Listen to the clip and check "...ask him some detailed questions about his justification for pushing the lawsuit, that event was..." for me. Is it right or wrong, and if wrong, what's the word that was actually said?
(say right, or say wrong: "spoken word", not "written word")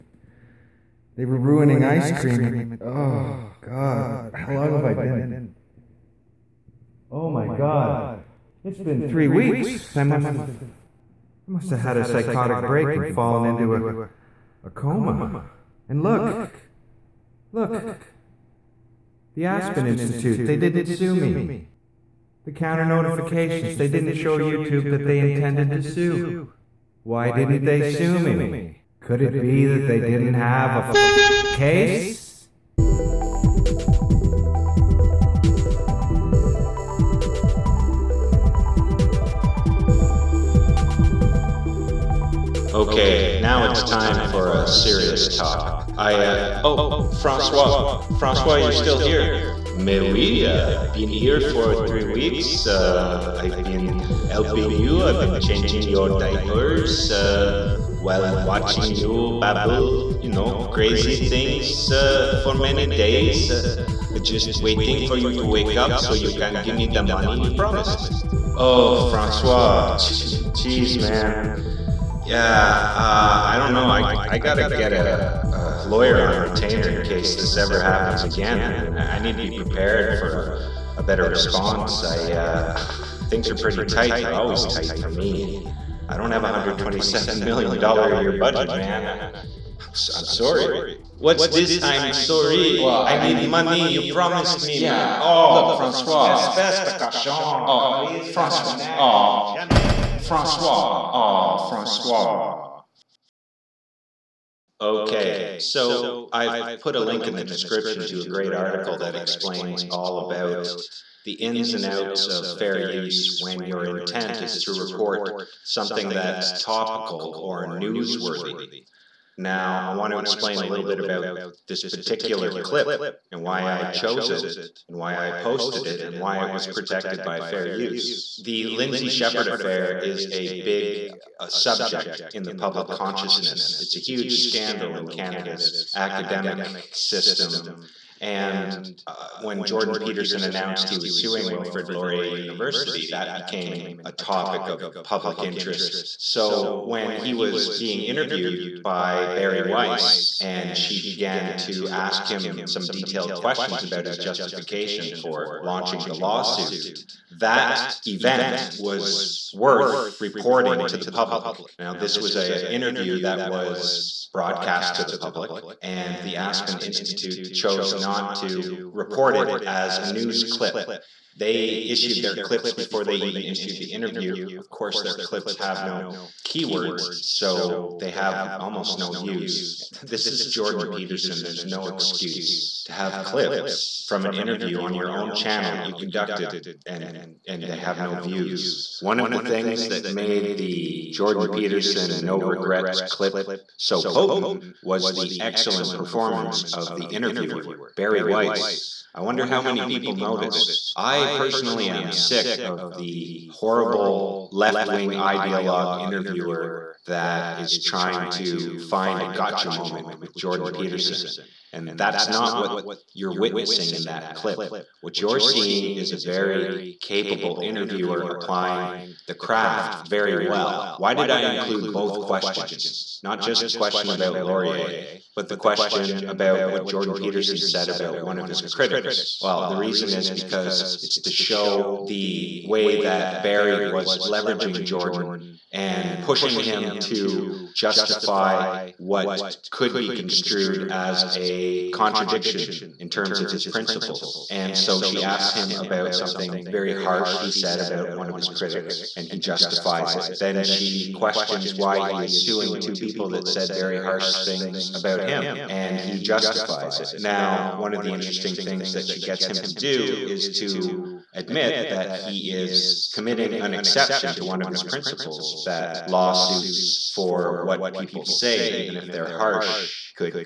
wrong: "launching", not "pushing".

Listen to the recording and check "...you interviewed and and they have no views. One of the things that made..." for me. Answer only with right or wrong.
wrong.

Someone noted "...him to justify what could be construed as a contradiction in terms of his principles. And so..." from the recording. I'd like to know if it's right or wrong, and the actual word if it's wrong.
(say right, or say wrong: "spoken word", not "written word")
right.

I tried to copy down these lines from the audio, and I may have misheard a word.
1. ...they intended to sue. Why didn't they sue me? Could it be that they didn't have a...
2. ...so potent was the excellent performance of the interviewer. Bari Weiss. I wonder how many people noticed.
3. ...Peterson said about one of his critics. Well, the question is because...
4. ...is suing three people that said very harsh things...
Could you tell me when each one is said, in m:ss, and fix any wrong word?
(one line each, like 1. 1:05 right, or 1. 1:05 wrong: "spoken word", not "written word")
1. 0:25 right
2. 3:13 right
3. 3:47 wrong: "reason", not "question"
4. 4:12 wrong: "two", not "three".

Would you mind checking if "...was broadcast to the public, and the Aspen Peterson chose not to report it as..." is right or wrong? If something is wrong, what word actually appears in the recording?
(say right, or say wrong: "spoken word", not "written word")
wrong: "Institute", not "Peterson".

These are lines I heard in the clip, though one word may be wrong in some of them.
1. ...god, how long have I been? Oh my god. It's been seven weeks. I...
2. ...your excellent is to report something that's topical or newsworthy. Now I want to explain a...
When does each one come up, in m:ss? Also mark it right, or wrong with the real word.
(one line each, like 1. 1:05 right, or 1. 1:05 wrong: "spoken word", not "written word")
1. 0:03 wrong: "three", not "seven"
2. 1:53 wrong: "intent", not "excellent".